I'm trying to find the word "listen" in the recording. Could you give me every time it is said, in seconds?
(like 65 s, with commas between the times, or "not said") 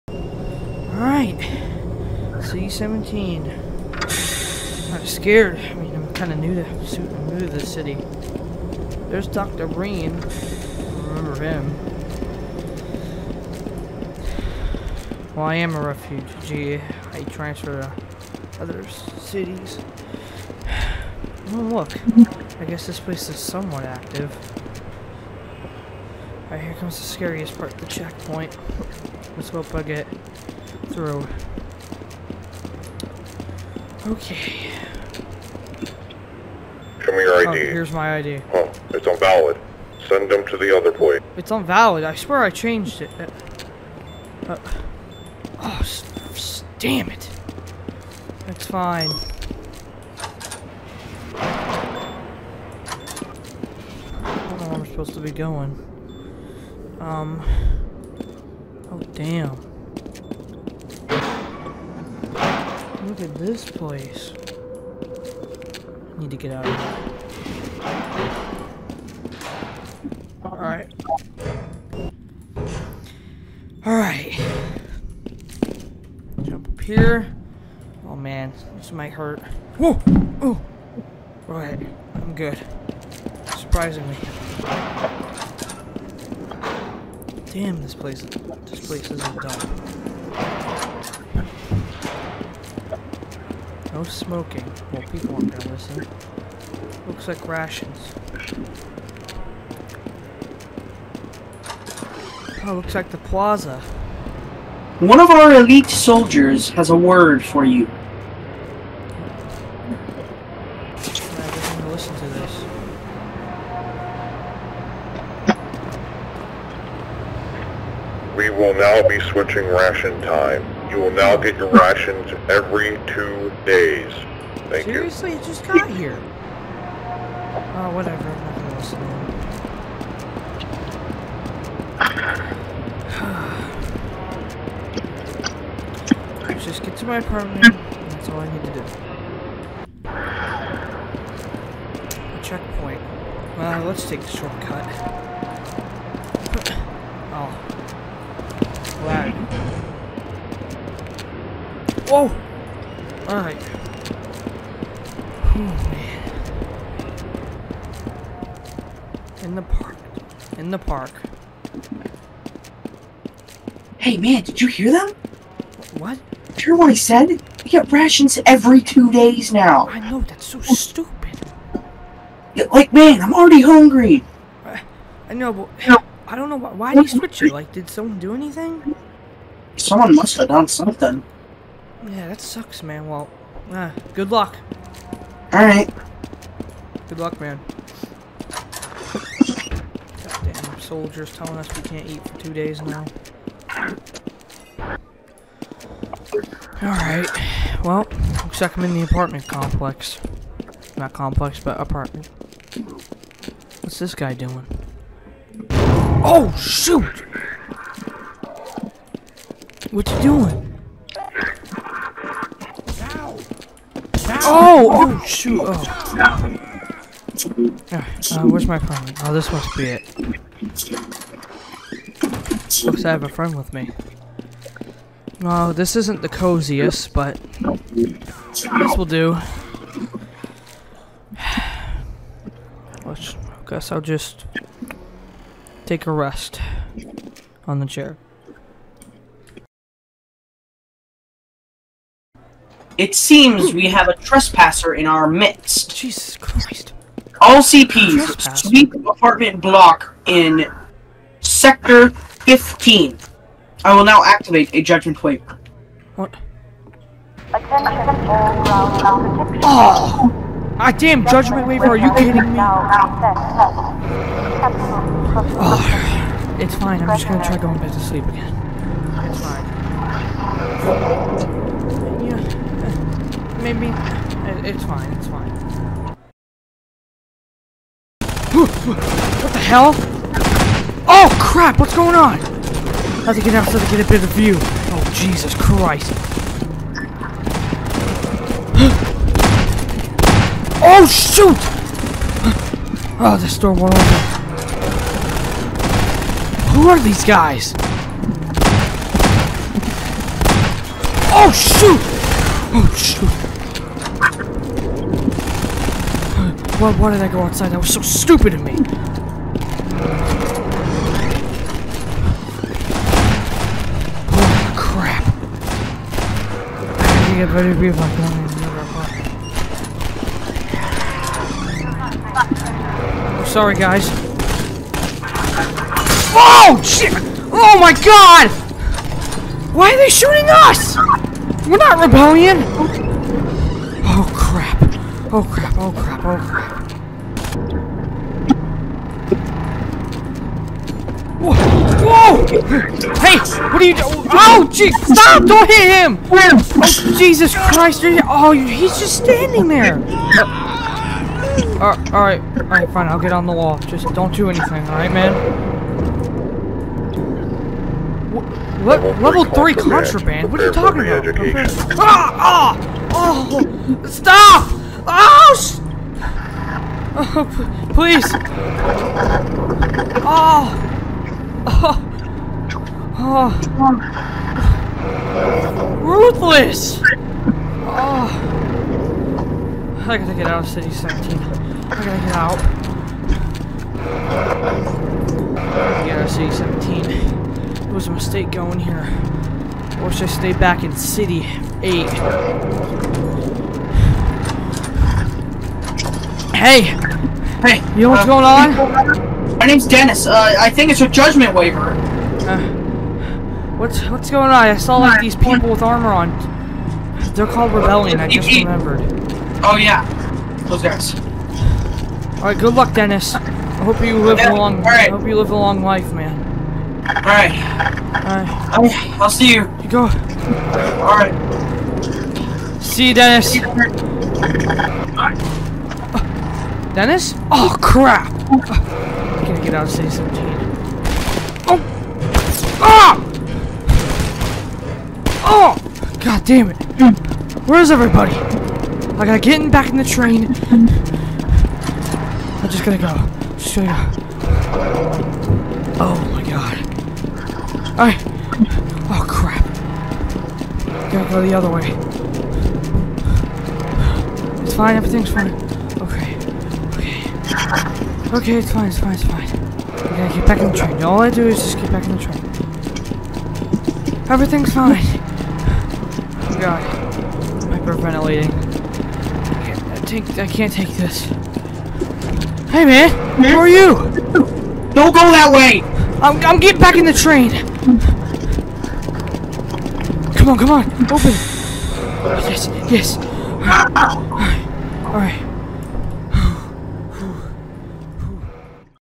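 95 s, 136 s.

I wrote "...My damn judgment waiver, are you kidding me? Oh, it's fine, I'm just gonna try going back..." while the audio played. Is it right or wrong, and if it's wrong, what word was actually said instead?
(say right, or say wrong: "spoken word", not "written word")
right.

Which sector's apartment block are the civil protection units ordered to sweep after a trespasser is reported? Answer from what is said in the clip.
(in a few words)
Sector 15.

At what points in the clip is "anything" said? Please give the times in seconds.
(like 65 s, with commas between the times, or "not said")
178 s, 354 s.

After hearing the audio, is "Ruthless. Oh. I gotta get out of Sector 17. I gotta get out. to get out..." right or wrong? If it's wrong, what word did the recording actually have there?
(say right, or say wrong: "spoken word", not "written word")
wrong: "City", not "Sector".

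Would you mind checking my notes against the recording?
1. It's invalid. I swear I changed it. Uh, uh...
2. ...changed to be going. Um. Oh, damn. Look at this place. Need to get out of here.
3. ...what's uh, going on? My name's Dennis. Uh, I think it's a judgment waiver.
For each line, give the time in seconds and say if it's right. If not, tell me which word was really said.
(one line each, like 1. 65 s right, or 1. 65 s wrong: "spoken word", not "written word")
1. 41 s right
2. 54 s wrong: "supposed", not "changed"
3. 398 s right.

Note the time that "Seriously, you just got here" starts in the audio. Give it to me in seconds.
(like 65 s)
124 s.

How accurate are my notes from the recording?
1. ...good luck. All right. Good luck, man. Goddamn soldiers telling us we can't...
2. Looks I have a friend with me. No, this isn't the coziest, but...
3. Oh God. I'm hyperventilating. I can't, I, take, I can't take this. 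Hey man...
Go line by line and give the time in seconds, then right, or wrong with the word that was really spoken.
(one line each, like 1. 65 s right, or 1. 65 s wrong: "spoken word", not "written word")
1. 184 s right
2. 222 s right
3. 466 s right.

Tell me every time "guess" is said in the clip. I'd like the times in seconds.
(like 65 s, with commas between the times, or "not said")
22 s, 233 s.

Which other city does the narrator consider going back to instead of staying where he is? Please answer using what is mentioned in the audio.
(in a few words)
City 8.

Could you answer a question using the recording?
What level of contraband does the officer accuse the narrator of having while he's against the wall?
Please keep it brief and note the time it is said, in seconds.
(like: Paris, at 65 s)
level three, at 359 s.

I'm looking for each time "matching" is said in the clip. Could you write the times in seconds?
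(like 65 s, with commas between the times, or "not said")
not said.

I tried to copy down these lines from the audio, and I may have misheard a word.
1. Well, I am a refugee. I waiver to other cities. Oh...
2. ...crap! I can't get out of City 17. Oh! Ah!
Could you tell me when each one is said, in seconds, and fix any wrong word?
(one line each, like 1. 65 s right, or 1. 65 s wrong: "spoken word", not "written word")
1. 15 s wrong: "transfer", not "waiver"
2. 427 s right.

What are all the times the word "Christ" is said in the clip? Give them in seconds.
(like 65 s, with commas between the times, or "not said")
246 s, 285 s, 347 s.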